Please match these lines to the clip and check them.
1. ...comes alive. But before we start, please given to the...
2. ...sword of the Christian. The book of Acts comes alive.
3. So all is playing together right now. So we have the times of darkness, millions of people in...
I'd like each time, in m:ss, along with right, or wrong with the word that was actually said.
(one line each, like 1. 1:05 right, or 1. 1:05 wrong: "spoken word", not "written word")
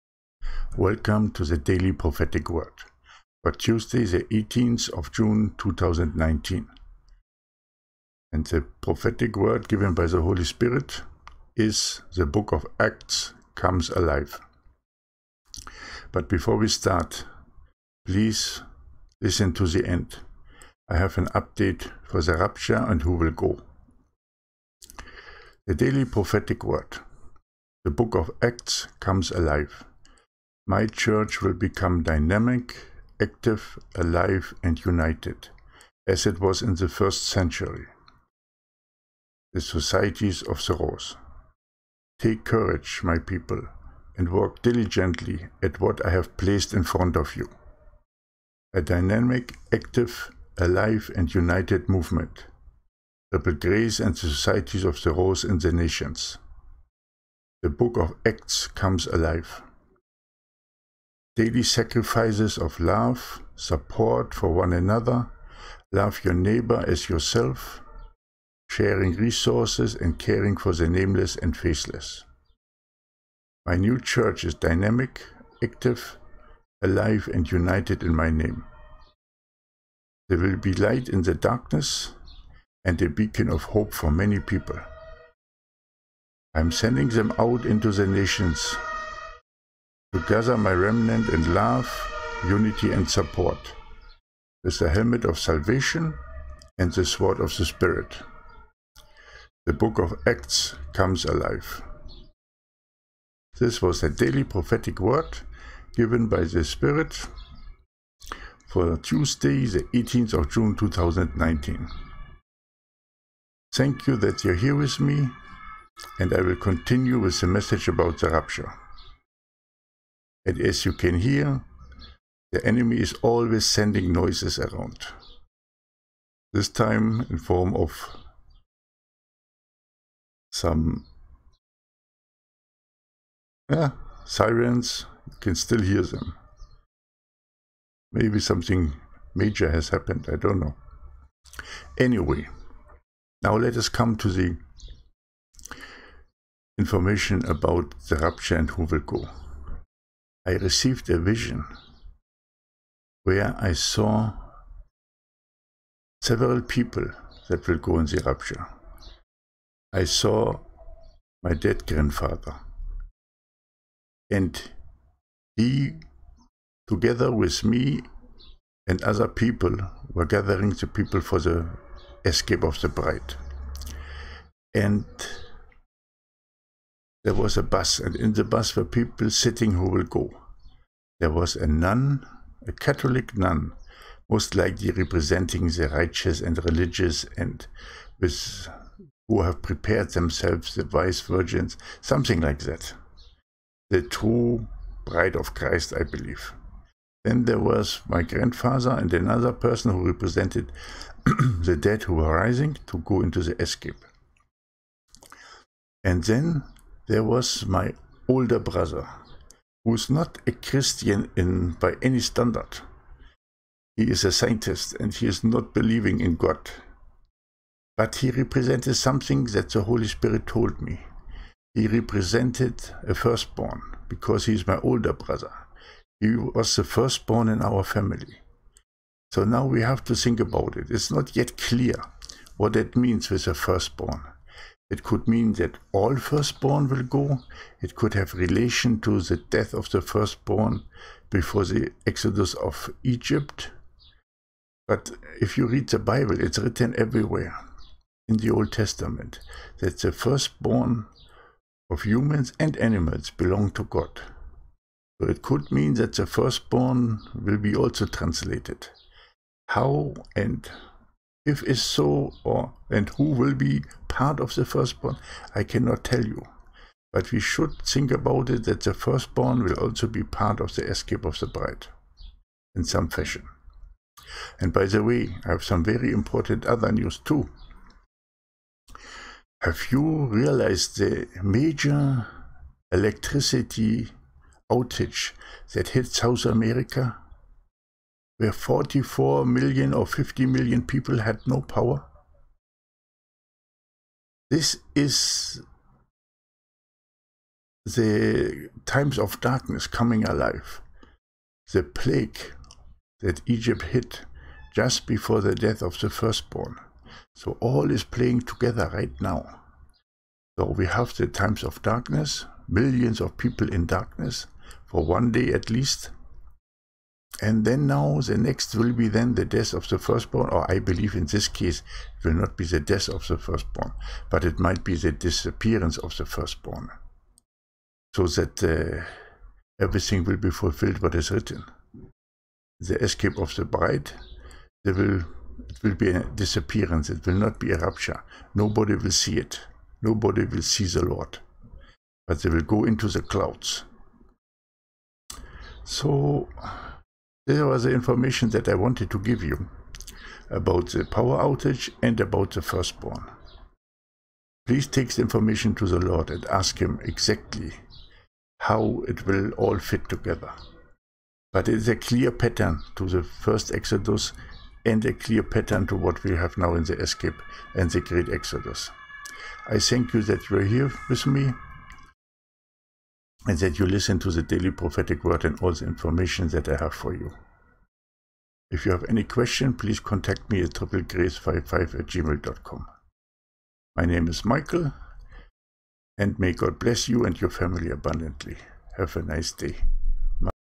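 1. 0:13 wrong: "listen", not "given"
2. 1:37 wrong: "Spirit", not "Christian"
3. 5:07 right.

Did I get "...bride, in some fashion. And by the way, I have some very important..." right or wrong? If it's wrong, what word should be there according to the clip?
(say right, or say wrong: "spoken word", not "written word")
right.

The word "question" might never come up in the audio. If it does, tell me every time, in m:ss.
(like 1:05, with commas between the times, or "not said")
6:19.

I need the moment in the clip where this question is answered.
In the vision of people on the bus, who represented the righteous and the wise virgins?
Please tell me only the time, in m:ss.
3:02.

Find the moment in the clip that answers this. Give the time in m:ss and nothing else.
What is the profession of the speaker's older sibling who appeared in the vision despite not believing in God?
3:34.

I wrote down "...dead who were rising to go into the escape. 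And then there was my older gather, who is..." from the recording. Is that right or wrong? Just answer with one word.
wrong.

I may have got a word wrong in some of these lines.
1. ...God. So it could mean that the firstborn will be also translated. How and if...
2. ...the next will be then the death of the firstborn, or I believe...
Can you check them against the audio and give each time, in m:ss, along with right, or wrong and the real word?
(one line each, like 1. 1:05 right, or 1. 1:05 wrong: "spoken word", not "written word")
1. 4:13 right
2. 5:18 right.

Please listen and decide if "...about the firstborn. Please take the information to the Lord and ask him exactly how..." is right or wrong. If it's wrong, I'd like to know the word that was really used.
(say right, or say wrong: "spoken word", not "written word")
right.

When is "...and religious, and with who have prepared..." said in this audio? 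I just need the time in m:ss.
3:06.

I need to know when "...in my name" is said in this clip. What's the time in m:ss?
1:18.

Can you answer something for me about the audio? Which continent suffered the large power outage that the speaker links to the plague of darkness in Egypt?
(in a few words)
South America.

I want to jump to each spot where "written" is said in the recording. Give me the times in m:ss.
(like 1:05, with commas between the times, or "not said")
4:06, 5:31.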